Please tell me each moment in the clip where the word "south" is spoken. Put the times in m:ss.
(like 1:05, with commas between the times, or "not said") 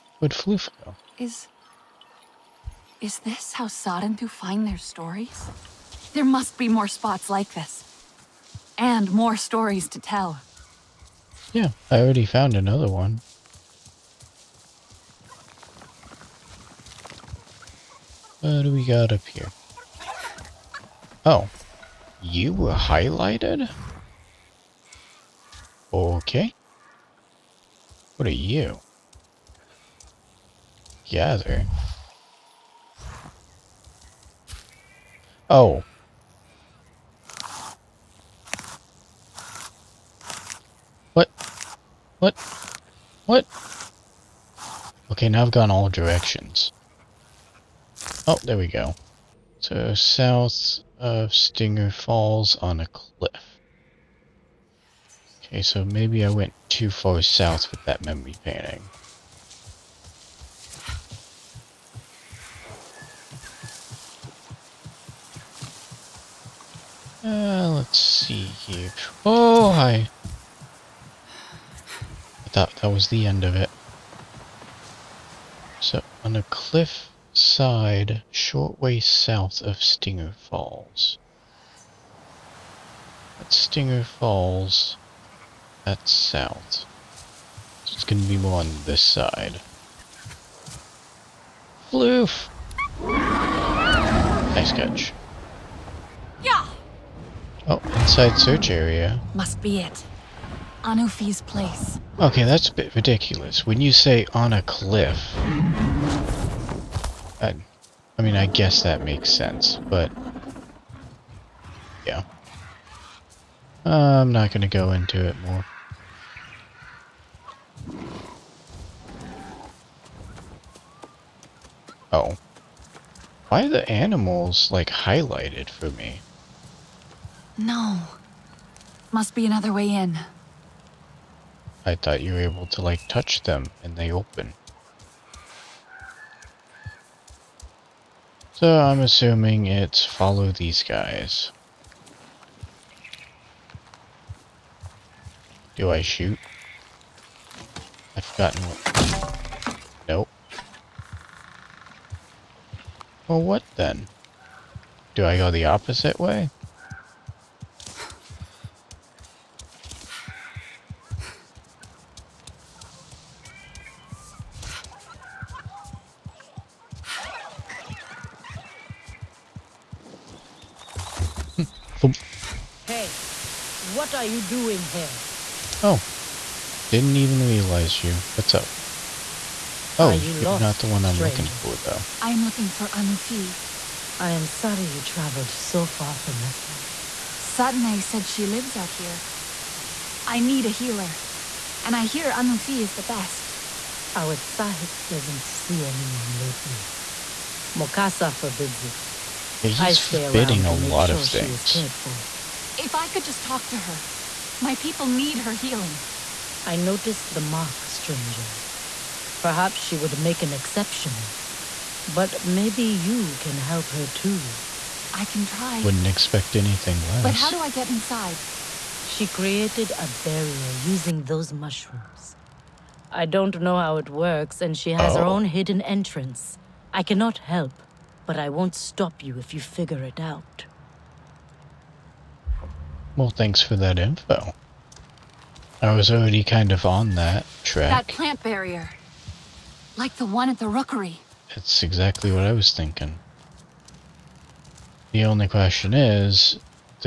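0:49, 0:57, 1:19, 1:26.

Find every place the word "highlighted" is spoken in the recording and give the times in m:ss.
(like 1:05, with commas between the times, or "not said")
0:22, 2:04.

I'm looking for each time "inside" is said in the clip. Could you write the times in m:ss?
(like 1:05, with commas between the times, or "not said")
1:38, 3:37.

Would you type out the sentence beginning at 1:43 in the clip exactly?
When you say on a cliff, mean, I guess that makes sense, but...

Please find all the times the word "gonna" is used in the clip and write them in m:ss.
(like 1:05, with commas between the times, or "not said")
1:28, 1:54.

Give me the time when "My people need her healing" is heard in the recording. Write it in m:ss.
3:24.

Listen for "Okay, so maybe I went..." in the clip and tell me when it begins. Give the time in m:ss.
0:55.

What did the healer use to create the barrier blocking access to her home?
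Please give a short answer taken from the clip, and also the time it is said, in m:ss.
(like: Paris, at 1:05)
Mushrooms, at 3:41.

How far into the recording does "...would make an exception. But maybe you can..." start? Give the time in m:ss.
3:29.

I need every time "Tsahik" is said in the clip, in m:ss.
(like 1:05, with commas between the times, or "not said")
3:14.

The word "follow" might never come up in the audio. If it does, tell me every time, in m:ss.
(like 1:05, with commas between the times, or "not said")
2:20.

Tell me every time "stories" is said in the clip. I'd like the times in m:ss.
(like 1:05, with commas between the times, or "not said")
0:04, 0:09.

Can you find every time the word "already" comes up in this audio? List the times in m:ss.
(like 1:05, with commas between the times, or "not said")
0:12, 3:56.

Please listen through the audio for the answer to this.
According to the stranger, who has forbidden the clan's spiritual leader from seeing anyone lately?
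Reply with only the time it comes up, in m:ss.
3:17.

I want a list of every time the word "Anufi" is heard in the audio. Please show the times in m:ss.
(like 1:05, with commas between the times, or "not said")
1:40, 3:02, 3:12.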